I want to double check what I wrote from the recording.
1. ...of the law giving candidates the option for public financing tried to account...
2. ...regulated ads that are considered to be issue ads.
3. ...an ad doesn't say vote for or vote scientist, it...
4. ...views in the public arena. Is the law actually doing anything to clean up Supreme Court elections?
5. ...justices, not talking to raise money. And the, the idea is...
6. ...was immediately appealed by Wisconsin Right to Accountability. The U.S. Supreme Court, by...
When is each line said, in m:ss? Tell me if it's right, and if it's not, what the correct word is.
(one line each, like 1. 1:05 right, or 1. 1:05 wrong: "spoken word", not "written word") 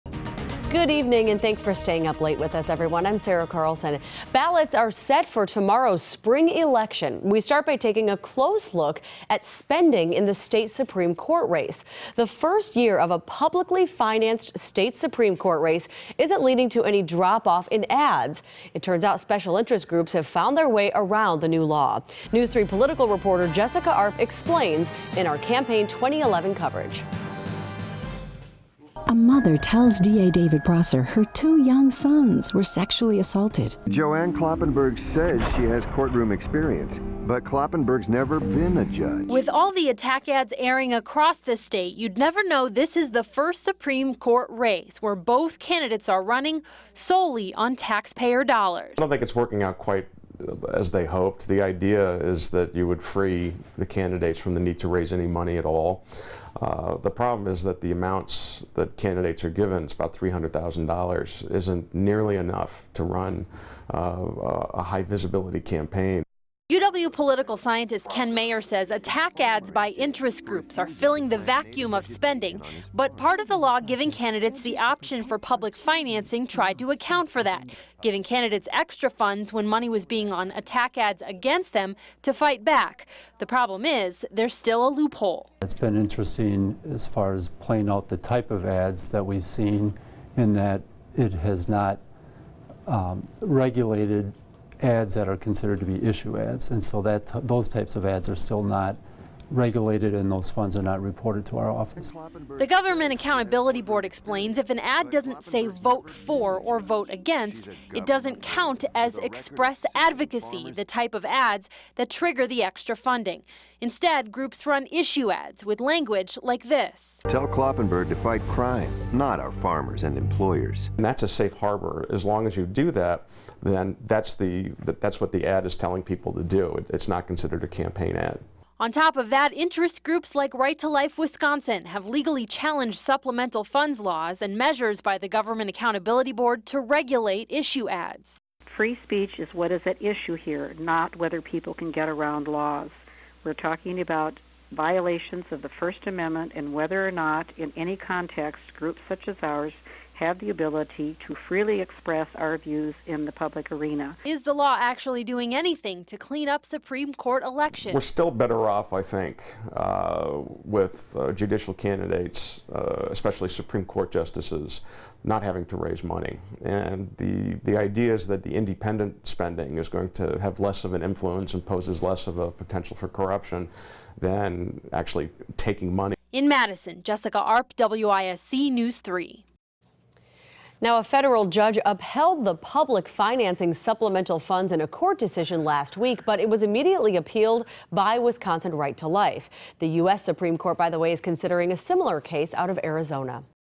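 1. 1:13 right
2. 1:33 right
3. 1:44 wrong: "against", not "scientist"
4. 2:32 right
5. 2:44 wrong: "having", not "talking"
6. 3:06 wrong: "Life", not "Accountability".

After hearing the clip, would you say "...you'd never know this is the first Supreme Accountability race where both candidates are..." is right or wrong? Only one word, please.
wrong.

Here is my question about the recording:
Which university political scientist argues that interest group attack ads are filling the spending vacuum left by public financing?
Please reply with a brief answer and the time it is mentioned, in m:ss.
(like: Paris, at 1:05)
Ken Mayer, at 1:08.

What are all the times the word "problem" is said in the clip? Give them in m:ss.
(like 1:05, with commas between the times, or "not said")
0:57, 1:23.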